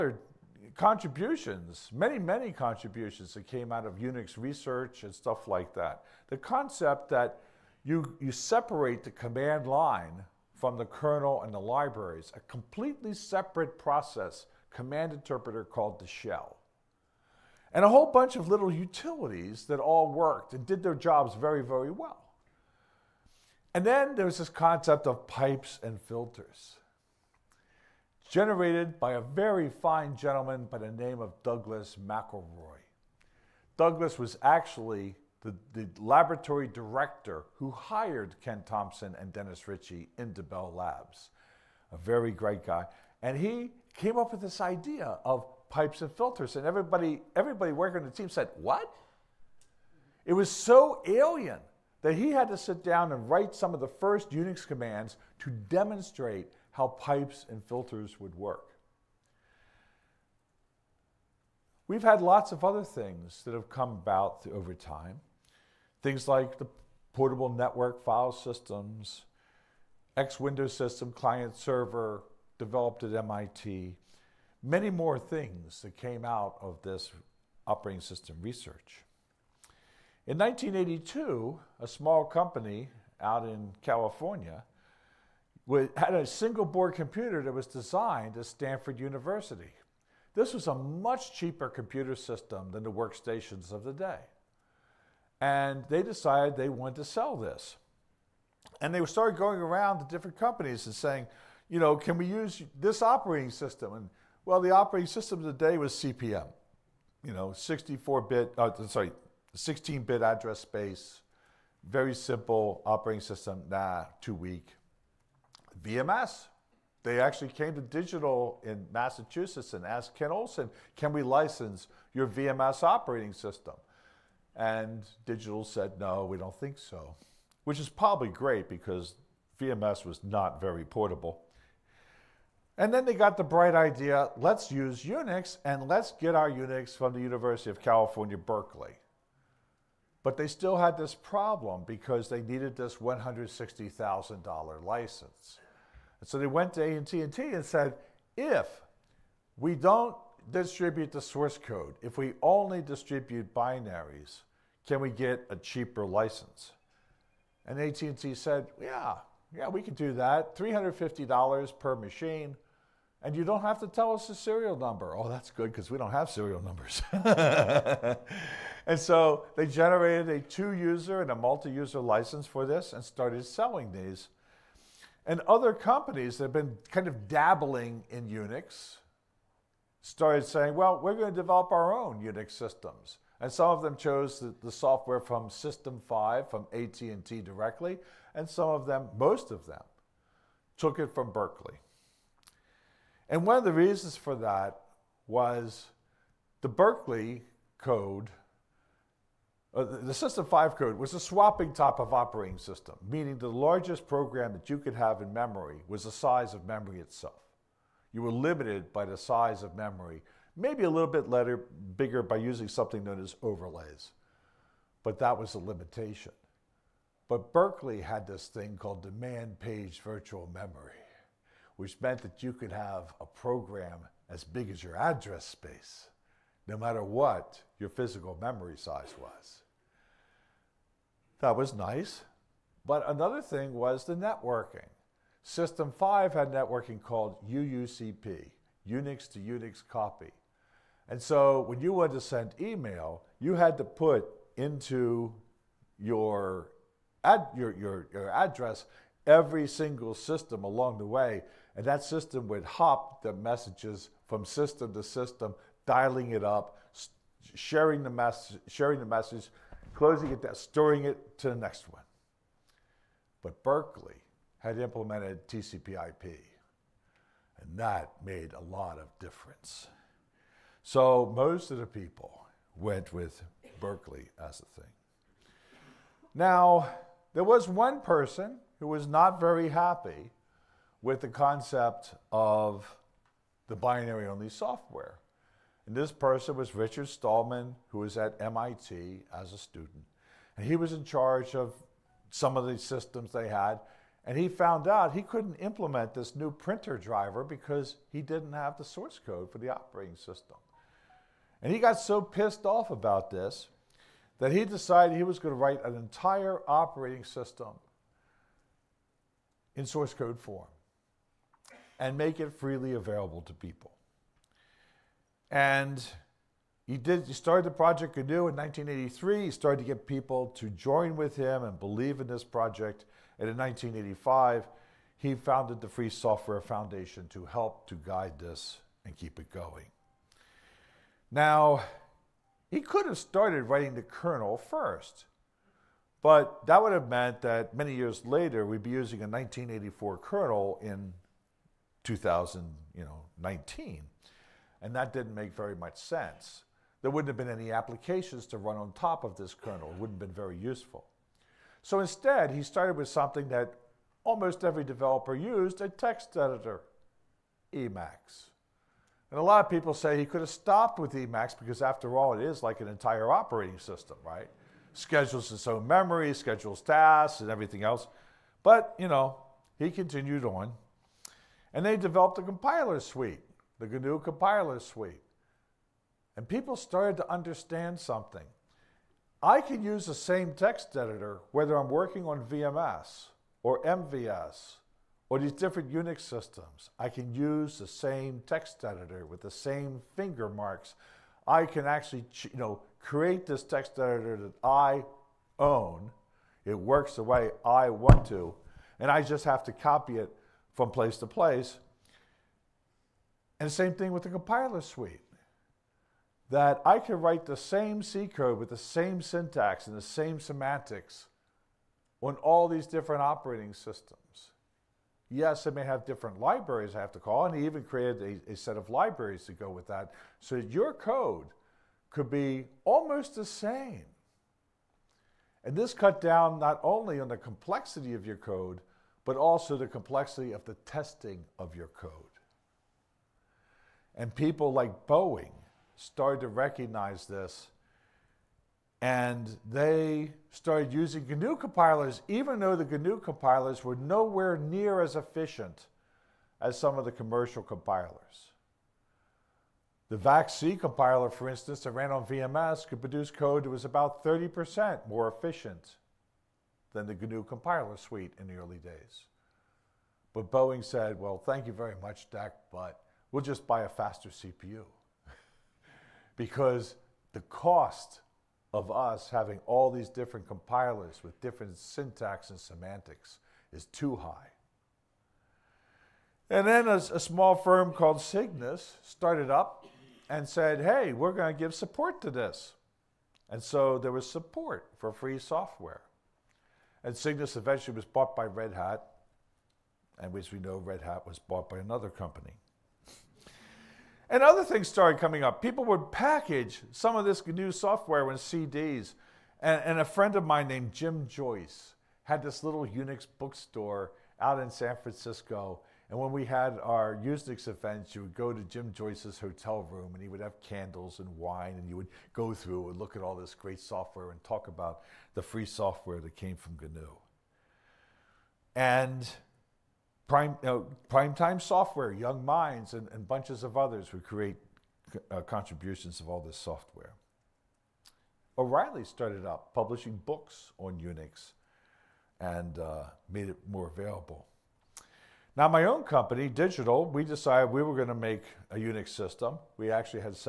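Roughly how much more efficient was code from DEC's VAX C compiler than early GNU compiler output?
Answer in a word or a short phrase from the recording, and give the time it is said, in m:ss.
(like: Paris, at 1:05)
30%, at 7:34.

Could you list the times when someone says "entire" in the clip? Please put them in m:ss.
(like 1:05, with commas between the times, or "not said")
5:05, 6:02.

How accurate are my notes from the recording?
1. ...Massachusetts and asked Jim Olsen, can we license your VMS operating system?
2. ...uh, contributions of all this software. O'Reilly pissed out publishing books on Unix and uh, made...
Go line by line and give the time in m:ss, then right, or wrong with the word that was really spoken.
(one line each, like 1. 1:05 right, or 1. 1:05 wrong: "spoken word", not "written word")
1. 1:58 wrong: "Ken", not "Jim"
2. 8:45 wrong: "started", not "pissed".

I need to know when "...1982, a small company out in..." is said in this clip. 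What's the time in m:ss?
1:20.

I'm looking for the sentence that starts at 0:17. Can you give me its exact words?
And a whole bunch of little utilities that all worked and did their jobs very, very well.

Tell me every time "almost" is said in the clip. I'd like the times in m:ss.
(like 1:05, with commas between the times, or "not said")
5:54, 7:02.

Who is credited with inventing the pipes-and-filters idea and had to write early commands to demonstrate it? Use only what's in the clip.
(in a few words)
Douglas McIlroy.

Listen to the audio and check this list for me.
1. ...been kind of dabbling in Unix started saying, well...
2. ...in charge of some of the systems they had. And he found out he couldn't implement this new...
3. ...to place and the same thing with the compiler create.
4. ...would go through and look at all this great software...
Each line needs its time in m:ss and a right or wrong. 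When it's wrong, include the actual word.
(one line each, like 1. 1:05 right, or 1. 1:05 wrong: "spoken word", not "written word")
1. 2:56 right
2. 4:50 right
3. 6:41 wrong: "suite", not "create"
4. 8:31 right.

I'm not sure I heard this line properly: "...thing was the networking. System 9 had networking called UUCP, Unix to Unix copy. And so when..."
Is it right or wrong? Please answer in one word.
wrong.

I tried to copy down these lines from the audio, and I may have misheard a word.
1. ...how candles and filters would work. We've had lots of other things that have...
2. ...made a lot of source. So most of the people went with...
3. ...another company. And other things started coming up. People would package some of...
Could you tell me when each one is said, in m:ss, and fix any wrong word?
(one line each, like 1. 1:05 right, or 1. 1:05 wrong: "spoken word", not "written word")
1. 0:56 wrong: "pipes", not "candles"
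2. 4:28 wrong: "difference", not "source"
3. 8:11 right.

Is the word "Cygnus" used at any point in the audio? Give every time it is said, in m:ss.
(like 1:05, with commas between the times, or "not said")
7:58, 8:07.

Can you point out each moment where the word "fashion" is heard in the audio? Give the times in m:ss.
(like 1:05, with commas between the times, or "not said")
not said.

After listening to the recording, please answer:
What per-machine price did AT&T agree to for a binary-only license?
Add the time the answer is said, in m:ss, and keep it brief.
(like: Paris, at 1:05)
$350, at 2:40.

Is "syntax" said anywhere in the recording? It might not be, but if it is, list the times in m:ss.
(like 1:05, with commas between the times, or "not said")
6:49, 7:51.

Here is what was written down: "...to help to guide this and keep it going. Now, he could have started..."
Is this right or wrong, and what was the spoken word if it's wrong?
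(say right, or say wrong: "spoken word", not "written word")
right.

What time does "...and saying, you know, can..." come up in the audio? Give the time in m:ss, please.
1:40.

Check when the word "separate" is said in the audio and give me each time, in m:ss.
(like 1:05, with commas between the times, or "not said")
0:08, 0:13.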